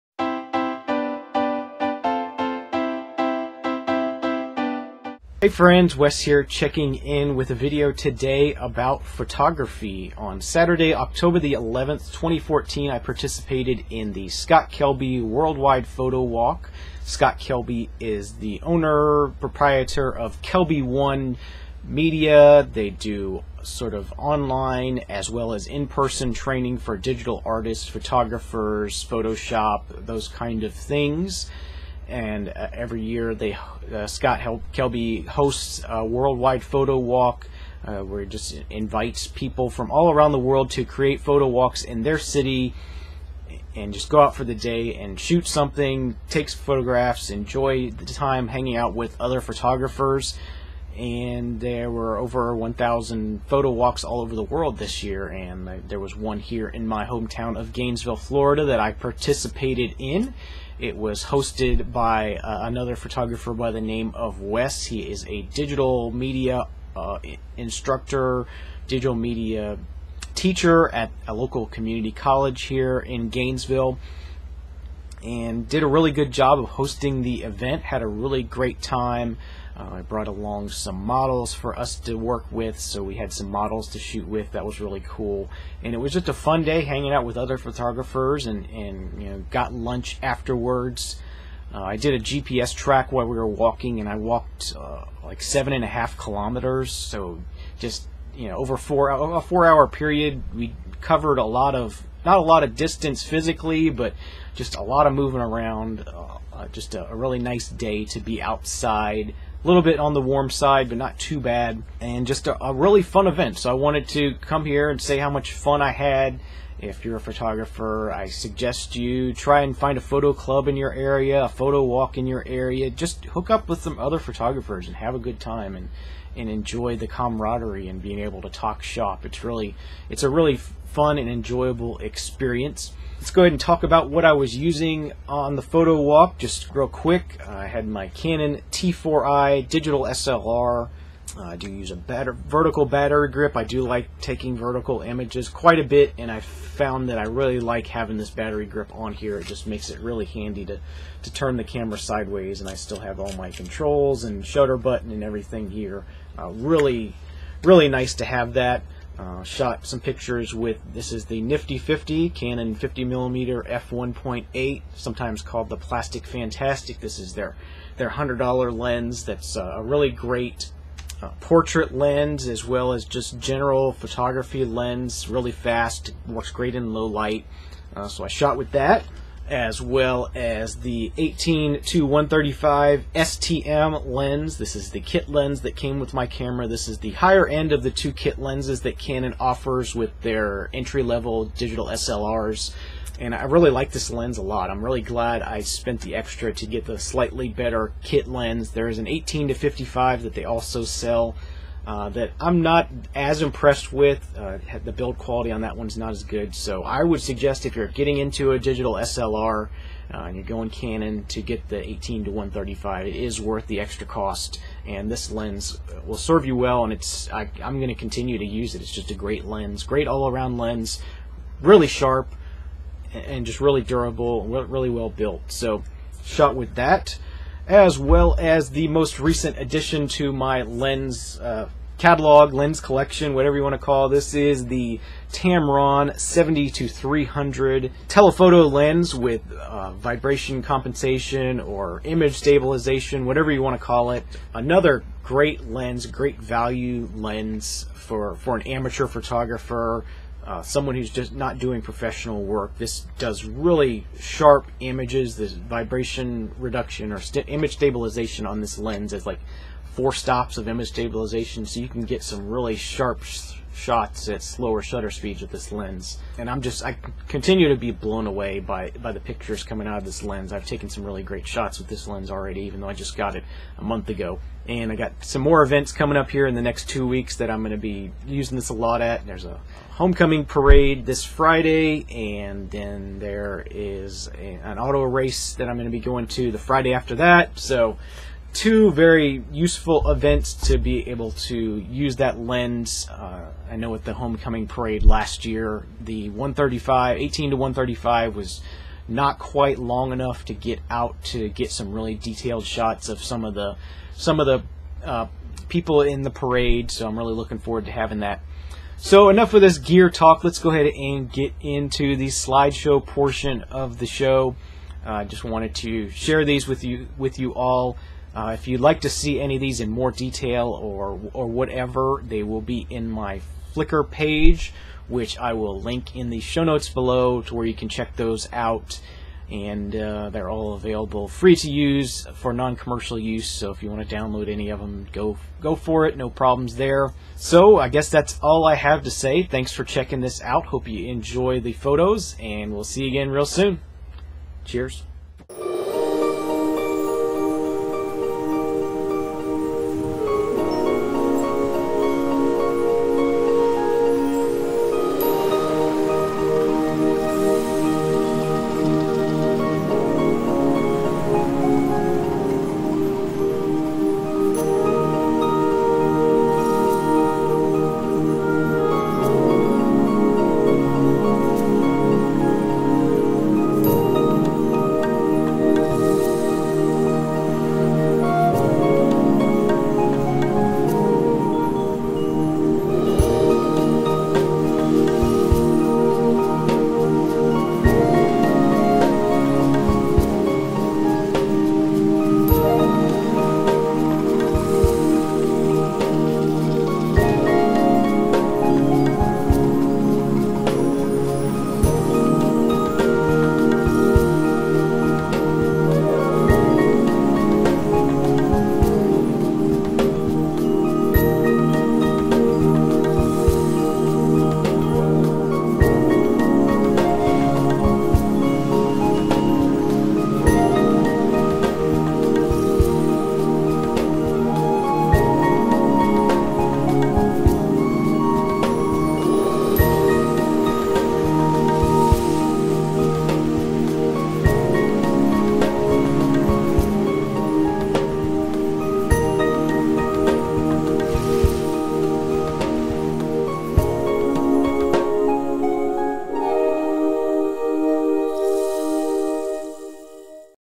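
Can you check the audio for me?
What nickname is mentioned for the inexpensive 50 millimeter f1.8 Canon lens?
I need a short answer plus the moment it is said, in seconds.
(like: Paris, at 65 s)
Plastic Fantastic, at 165 s.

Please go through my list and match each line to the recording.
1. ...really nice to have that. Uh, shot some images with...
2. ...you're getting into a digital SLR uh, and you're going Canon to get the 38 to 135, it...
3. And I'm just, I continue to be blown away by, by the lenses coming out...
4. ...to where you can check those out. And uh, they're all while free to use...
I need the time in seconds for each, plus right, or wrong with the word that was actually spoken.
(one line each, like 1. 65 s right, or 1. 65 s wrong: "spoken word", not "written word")
1. 157 s wrong: "pictures", not "images"
2. 207 s wrong: "18", not "38"
3. 266 s wrong: "pictures", not "lenses"
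4. 327 s wrong: "available", not "while".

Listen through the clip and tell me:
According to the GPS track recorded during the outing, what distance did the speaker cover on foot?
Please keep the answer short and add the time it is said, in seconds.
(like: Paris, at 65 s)
7.5 kilometers, at 95 s.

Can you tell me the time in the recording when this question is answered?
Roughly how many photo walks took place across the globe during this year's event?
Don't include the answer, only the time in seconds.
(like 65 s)
52 s.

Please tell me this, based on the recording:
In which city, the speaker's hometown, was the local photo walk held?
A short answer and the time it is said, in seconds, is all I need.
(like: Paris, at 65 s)
Gainesville, Florida, at 57 s.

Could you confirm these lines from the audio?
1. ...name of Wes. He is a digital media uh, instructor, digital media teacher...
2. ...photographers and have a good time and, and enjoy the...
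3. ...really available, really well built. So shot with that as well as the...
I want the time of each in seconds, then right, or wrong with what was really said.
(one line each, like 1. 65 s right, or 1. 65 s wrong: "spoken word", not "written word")
1. 63 s right
2. 124 s right
3. 223 s wrong: "durable", not "available".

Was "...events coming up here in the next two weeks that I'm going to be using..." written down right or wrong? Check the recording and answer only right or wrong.
right.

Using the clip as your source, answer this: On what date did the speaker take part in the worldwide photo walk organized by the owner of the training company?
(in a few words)
October 11, 2014.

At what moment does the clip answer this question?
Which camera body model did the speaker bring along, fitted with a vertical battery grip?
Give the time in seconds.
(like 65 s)
138 s.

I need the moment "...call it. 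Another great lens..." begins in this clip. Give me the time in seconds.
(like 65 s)
243 s.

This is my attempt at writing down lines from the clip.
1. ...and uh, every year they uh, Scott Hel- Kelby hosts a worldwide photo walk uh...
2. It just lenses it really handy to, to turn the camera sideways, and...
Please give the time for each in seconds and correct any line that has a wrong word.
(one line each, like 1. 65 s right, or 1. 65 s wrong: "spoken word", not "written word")
1. 32 s right
2. 149 s wrong: "makes", not "lenses".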